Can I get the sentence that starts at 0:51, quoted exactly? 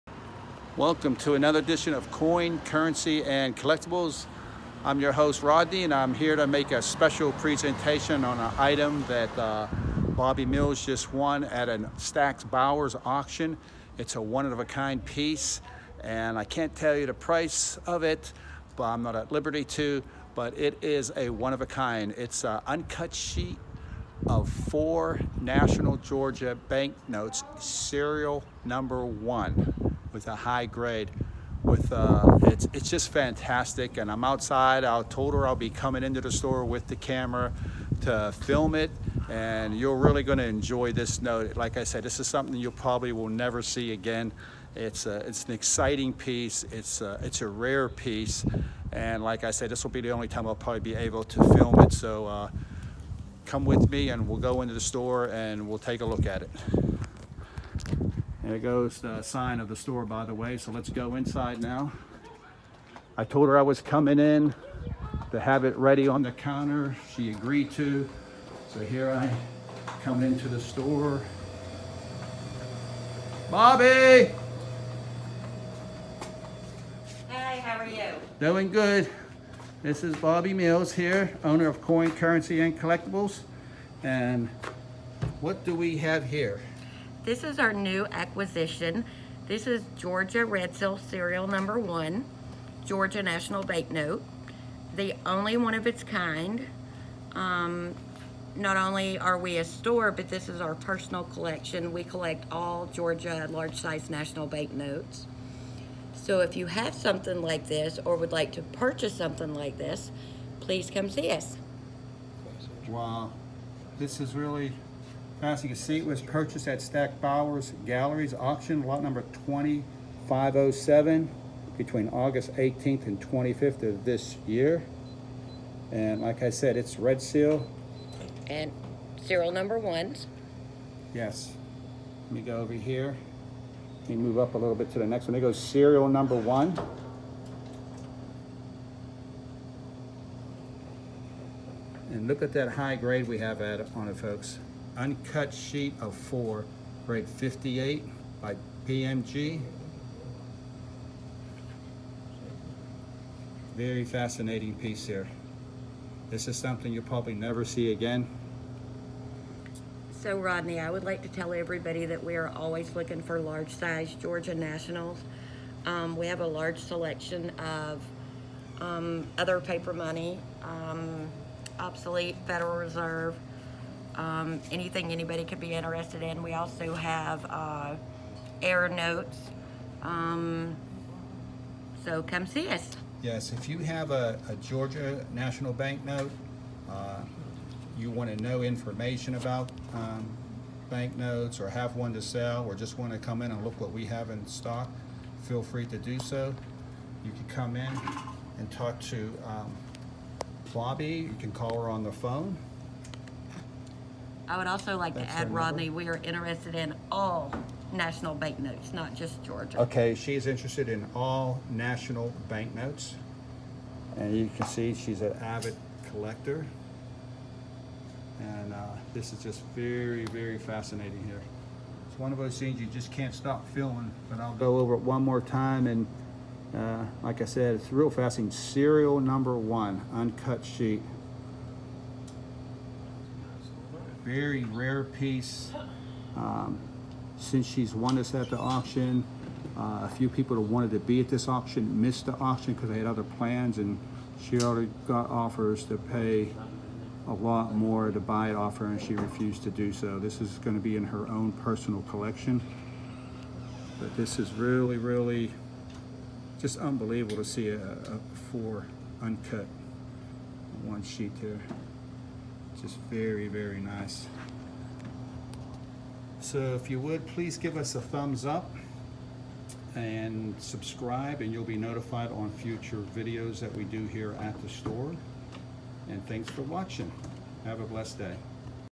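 So uh, come with me, and we'll go into the store and we'll take a look at it.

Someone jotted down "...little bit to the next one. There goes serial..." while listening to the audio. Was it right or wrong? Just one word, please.
right.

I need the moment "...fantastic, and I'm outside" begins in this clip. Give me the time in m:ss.
0:33.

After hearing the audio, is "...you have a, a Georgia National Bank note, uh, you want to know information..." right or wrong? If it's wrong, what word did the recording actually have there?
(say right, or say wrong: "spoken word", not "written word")
right.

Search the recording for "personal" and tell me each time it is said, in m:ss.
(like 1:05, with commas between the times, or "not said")
1:40, 4:11.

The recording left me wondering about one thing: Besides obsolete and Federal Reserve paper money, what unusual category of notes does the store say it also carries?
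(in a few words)
Error notes.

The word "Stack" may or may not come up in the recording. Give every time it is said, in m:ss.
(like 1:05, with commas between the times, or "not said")
0:11, 1:56.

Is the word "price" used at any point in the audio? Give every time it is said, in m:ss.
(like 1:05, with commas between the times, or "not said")
0:17.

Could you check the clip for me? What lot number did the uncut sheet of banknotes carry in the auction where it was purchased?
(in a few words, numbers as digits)
2507.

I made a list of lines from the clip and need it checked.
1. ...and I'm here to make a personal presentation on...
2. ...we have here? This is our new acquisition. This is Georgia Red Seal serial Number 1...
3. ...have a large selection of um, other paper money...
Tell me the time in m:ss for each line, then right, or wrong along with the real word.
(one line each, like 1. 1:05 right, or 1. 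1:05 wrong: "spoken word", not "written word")
1. 0:05 wrong: "special", not "personal"
2. 1:25 right
3. 2:46 right.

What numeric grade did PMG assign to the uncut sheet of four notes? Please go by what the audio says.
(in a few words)
58.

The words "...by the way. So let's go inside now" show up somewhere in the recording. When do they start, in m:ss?
1:00.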